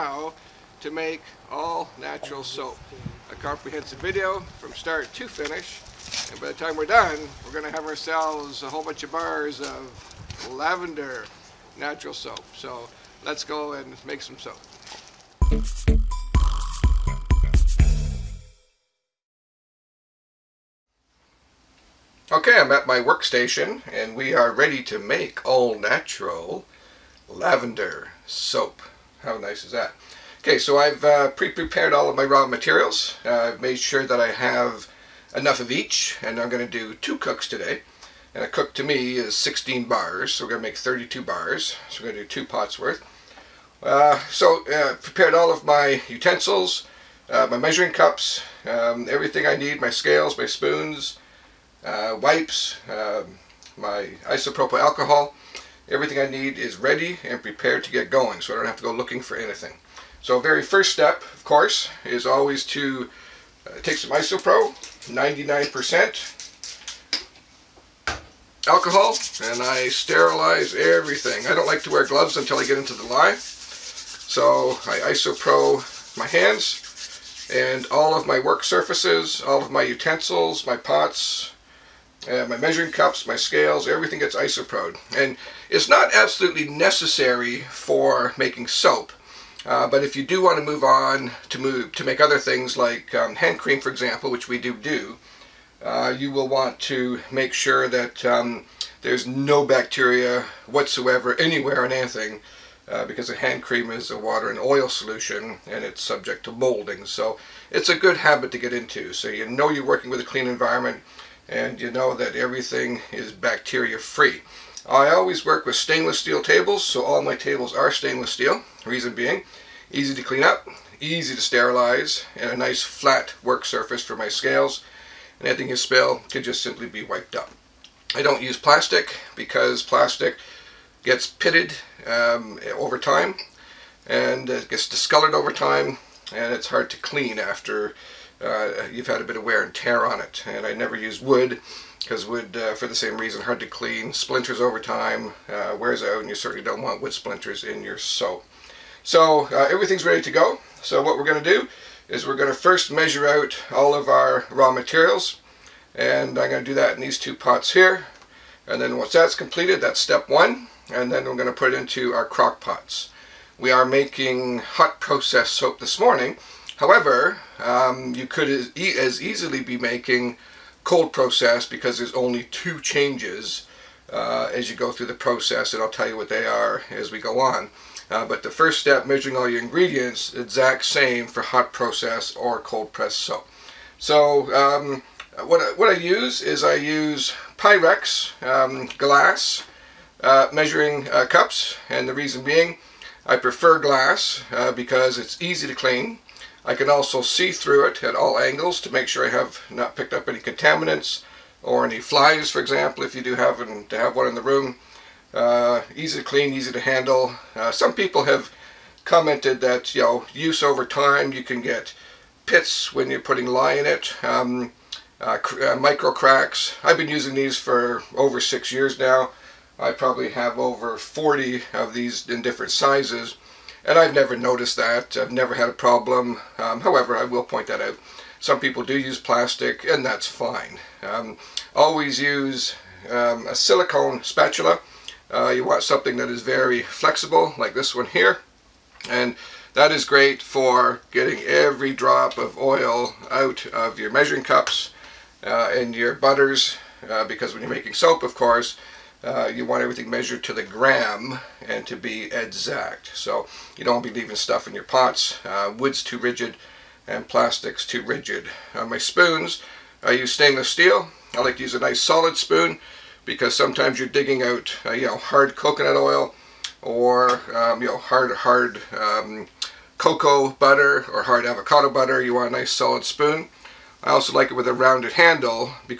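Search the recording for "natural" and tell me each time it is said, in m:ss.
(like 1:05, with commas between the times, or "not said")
0:01, 0:11, 0:25.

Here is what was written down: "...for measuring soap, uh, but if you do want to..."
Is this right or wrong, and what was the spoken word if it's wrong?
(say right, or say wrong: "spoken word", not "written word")
wrong: "making", not "measuring".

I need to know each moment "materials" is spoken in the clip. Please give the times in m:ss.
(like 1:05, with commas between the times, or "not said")
0:32, 2:34.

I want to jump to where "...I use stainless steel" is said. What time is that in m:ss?
4:20.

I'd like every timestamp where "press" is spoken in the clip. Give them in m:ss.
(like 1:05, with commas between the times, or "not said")
3:02.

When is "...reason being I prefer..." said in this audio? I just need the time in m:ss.
3:12.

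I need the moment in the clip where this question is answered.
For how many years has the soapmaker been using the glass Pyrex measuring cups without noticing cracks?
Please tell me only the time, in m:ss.
3:38.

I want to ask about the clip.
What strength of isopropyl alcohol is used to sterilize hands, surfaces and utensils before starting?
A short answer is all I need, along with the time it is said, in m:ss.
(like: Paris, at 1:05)
99%, at 1:05.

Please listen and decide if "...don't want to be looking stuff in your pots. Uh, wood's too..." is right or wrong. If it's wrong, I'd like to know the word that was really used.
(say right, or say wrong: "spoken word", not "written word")
wrong: "leaving", not "looking".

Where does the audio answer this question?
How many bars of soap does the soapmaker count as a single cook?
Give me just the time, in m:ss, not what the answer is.
0:39.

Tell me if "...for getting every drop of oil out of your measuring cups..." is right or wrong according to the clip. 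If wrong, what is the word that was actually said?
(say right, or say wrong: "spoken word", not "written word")
right.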